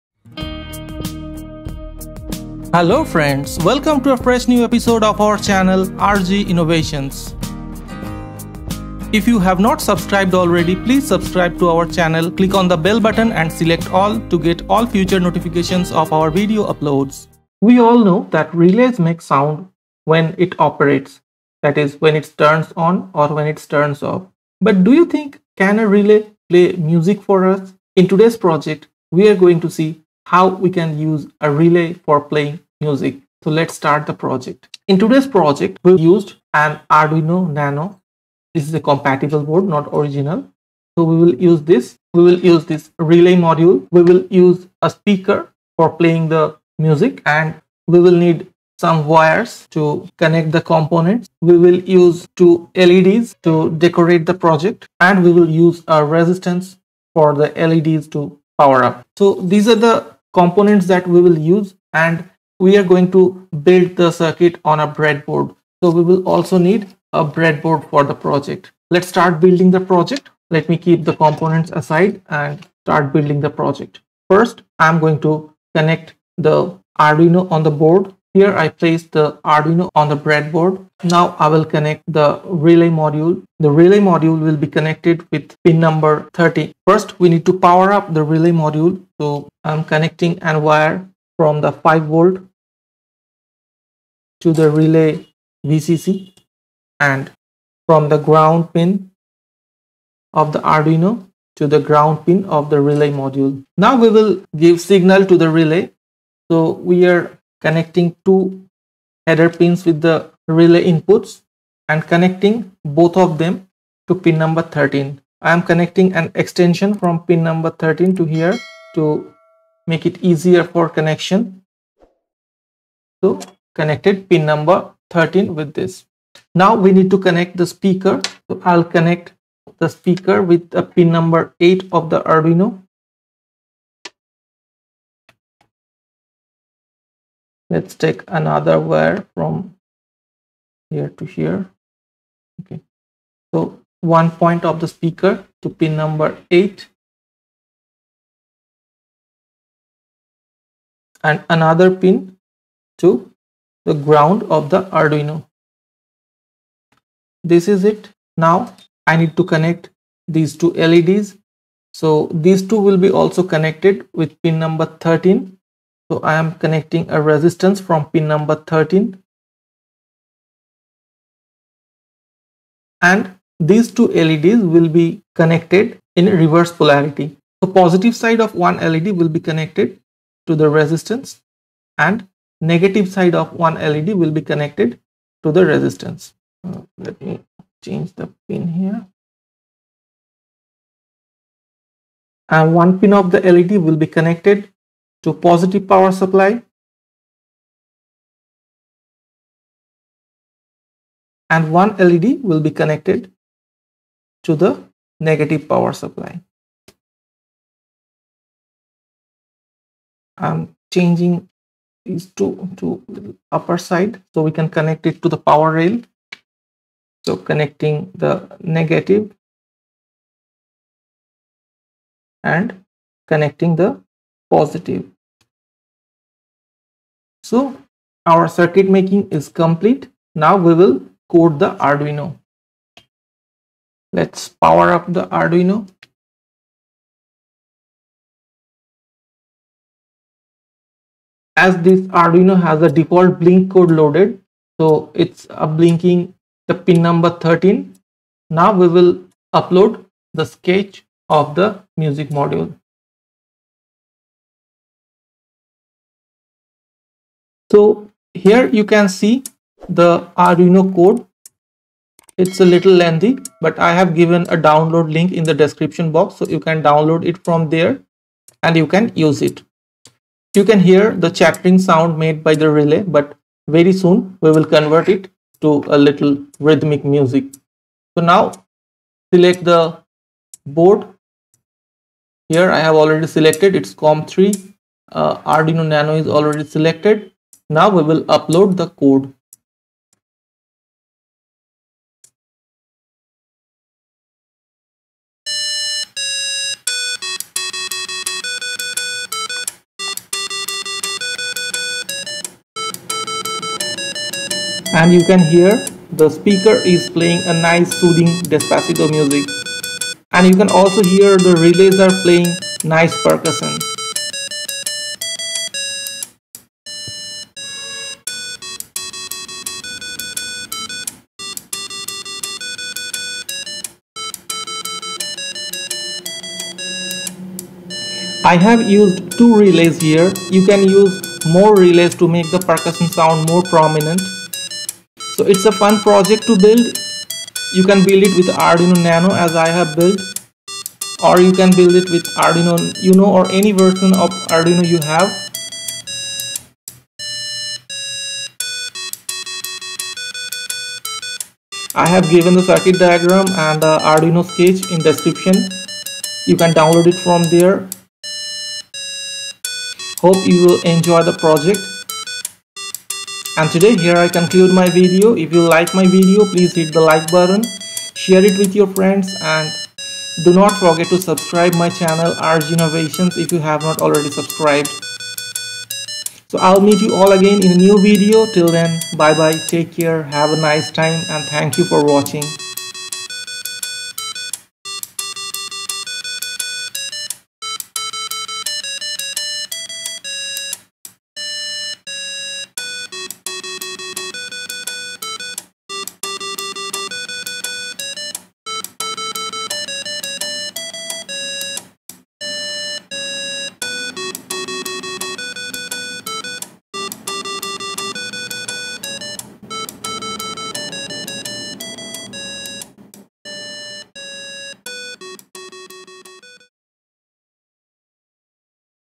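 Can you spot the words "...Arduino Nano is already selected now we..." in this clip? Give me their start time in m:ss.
4:45.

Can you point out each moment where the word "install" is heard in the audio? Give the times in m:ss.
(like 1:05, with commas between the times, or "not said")
not said.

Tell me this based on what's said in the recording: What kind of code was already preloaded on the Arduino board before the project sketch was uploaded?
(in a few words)
Default blink code.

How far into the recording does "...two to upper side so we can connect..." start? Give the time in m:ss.
3:32.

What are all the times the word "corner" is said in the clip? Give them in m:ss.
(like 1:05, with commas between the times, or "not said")
not said.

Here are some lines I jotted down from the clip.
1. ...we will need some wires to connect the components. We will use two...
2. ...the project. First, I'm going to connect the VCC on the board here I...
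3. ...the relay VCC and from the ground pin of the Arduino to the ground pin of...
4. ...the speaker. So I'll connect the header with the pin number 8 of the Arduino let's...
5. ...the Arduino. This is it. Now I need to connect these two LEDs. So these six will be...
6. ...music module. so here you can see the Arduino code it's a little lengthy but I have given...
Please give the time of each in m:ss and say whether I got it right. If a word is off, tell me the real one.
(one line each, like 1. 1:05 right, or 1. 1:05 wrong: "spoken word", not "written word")
1. 0:47 right
2. 1:13 wrong: "Arduino", not "VCC"
3. 1:34 right
4. 2:07 wrong: "speaker", not "header"
5. 2:34 wrong: "two", not "six"
6. 4:11 right.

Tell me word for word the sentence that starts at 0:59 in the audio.
So these are the components that we will use and we are going to build the circuit on a breadboard.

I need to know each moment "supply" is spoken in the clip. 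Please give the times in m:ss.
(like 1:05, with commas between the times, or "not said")
3:16, 3:25.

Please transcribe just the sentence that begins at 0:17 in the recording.
We all know that relays make sound when it operates, that is when it turns on or when it turns off.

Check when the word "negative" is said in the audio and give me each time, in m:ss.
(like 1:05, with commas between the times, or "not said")
3:02, 3:25, 3:38.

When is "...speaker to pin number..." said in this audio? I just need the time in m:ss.
2:24.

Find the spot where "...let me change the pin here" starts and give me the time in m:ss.
3:06.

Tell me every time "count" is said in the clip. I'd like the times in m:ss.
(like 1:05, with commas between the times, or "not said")
not said.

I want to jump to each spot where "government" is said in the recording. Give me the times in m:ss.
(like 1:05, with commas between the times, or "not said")
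not said.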